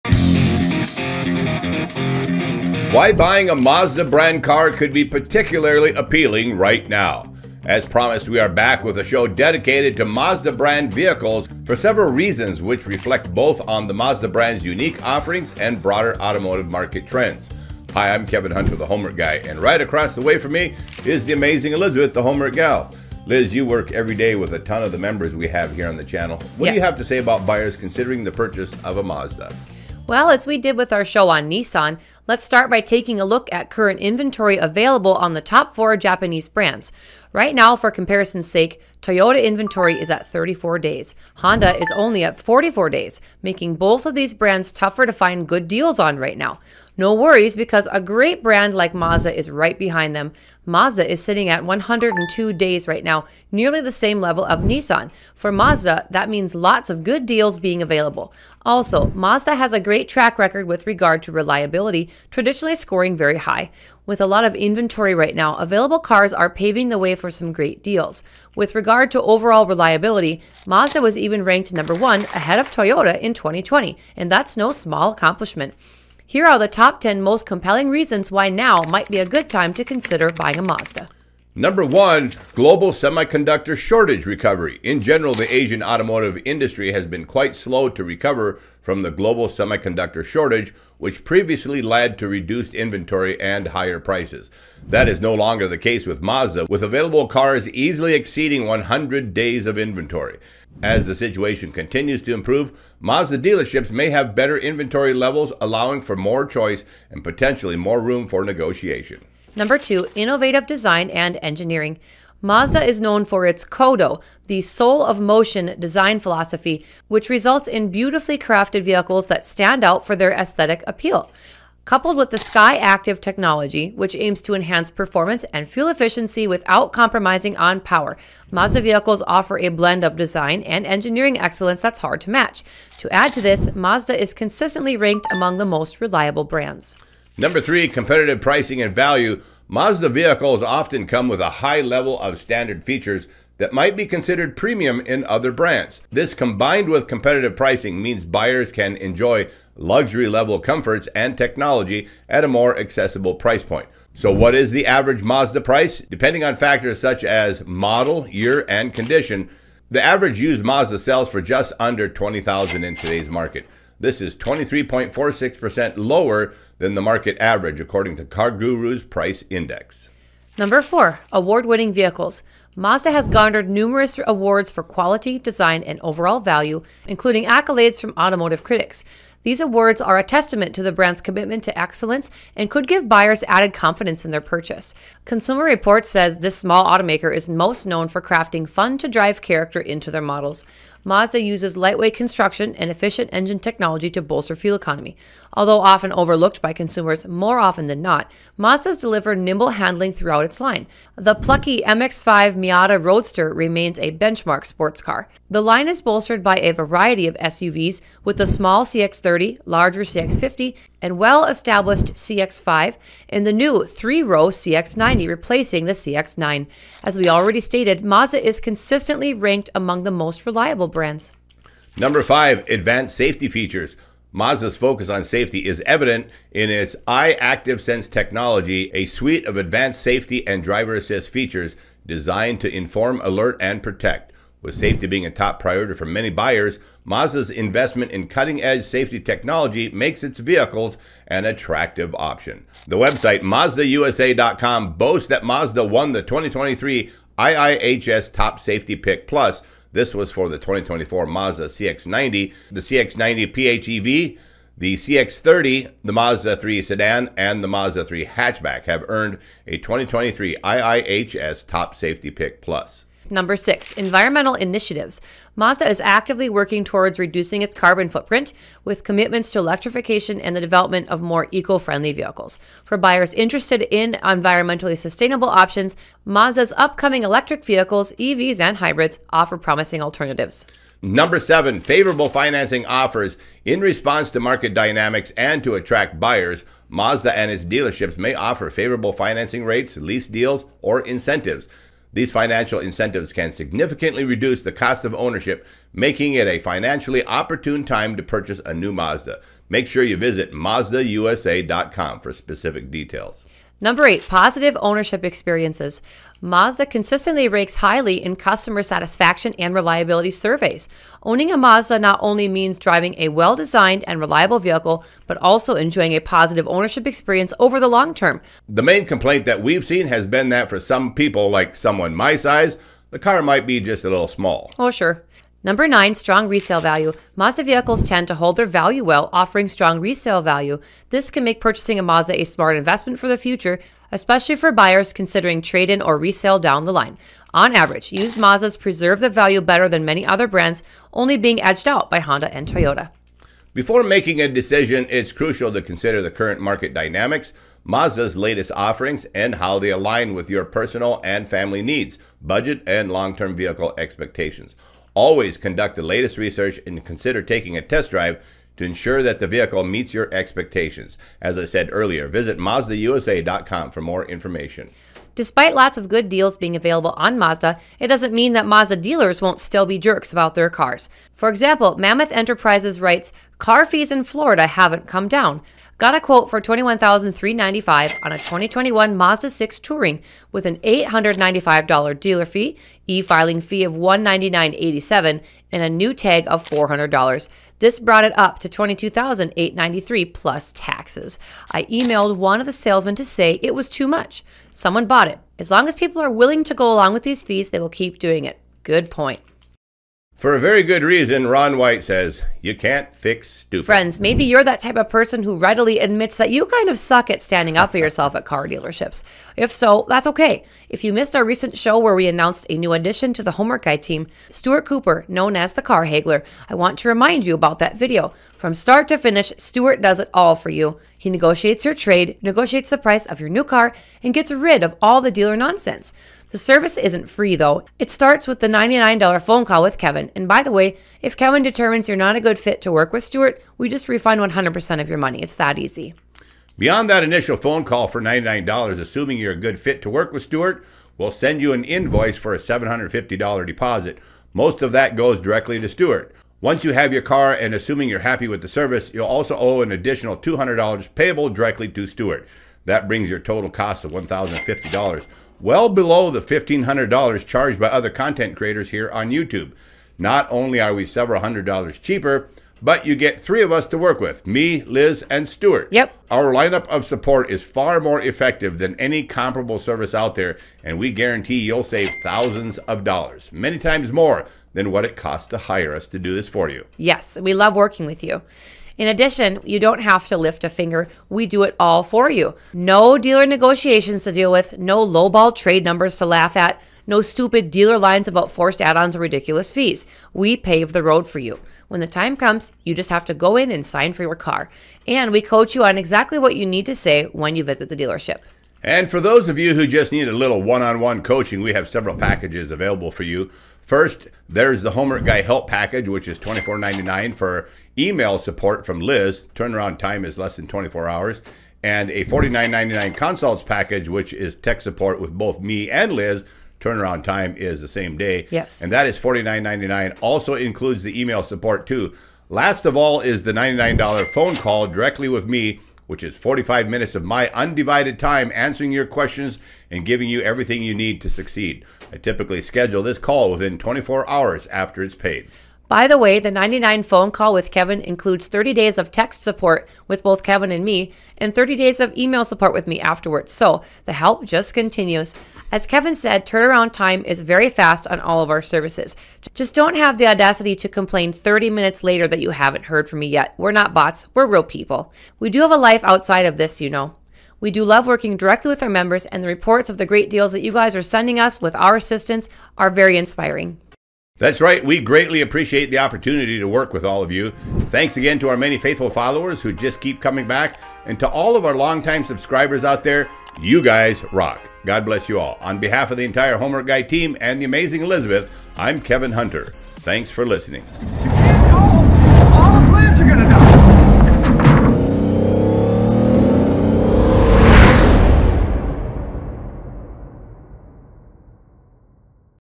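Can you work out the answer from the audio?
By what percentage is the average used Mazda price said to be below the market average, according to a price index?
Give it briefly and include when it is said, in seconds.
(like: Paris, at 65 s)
23.46%, at 164 s.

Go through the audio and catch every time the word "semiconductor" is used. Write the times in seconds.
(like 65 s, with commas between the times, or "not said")
82 s, 89 s.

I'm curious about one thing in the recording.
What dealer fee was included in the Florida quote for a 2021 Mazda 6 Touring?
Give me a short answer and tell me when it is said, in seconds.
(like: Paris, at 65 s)
$895, at 380 s.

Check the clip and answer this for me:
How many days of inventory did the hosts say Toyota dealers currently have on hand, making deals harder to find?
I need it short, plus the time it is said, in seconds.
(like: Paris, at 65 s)
34 days, at 40 s.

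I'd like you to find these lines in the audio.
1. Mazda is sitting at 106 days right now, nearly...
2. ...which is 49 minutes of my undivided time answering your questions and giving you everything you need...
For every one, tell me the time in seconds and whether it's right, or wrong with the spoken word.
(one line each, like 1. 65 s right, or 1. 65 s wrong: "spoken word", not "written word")
1. 50 s wrong: "102", not "106"
2. 526 s wrong: "45", not "49".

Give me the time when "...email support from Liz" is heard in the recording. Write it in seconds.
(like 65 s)
507 s.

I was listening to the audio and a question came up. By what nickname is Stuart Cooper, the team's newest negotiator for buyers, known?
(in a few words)
the Car Haggler.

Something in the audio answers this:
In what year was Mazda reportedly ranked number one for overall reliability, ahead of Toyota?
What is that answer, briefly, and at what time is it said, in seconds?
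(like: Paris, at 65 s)
2020, at 73 s.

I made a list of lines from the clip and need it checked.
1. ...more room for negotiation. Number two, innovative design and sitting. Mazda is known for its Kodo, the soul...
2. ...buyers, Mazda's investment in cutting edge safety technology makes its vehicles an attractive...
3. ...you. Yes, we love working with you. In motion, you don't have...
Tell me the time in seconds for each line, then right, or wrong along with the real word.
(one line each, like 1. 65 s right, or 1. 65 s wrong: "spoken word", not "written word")
1. 107 s wrong: "engineering", not "sitting"
2. 236 s right
3. 476 s wrong: "addition", not "motion".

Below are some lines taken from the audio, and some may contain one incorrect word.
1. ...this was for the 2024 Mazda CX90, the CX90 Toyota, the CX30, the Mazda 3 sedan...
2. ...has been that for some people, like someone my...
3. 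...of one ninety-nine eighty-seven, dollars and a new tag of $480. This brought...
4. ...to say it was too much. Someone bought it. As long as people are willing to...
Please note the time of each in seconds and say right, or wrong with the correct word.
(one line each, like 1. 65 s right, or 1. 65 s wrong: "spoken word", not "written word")
1. 249 s wrong: "PHEV", not "Toyota"
2. 320 s right
3. 383 s wrong: "400", not "480"
4. 393 s right.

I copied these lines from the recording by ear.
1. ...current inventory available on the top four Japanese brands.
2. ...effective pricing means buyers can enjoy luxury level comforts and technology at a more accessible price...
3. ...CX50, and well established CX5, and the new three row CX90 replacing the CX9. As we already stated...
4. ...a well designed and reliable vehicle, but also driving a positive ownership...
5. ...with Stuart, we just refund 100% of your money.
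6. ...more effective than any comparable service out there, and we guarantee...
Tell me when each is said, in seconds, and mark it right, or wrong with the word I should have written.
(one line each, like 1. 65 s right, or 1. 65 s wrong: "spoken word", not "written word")
1. 33 s right
2. 147 s wrong: "competitive", not "effective"
3. 210 s right
4. 313 s wrong: "enjoying", not "driving"
5. 433 s right
6. 467 s right.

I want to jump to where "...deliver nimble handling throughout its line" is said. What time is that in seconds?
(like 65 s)
198 s.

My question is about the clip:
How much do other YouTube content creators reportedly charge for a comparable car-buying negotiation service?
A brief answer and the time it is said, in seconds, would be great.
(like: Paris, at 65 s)
$1,500, at 456 s.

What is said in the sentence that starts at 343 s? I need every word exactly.
Before making a decision, it's crucial to consider the current market dynamics.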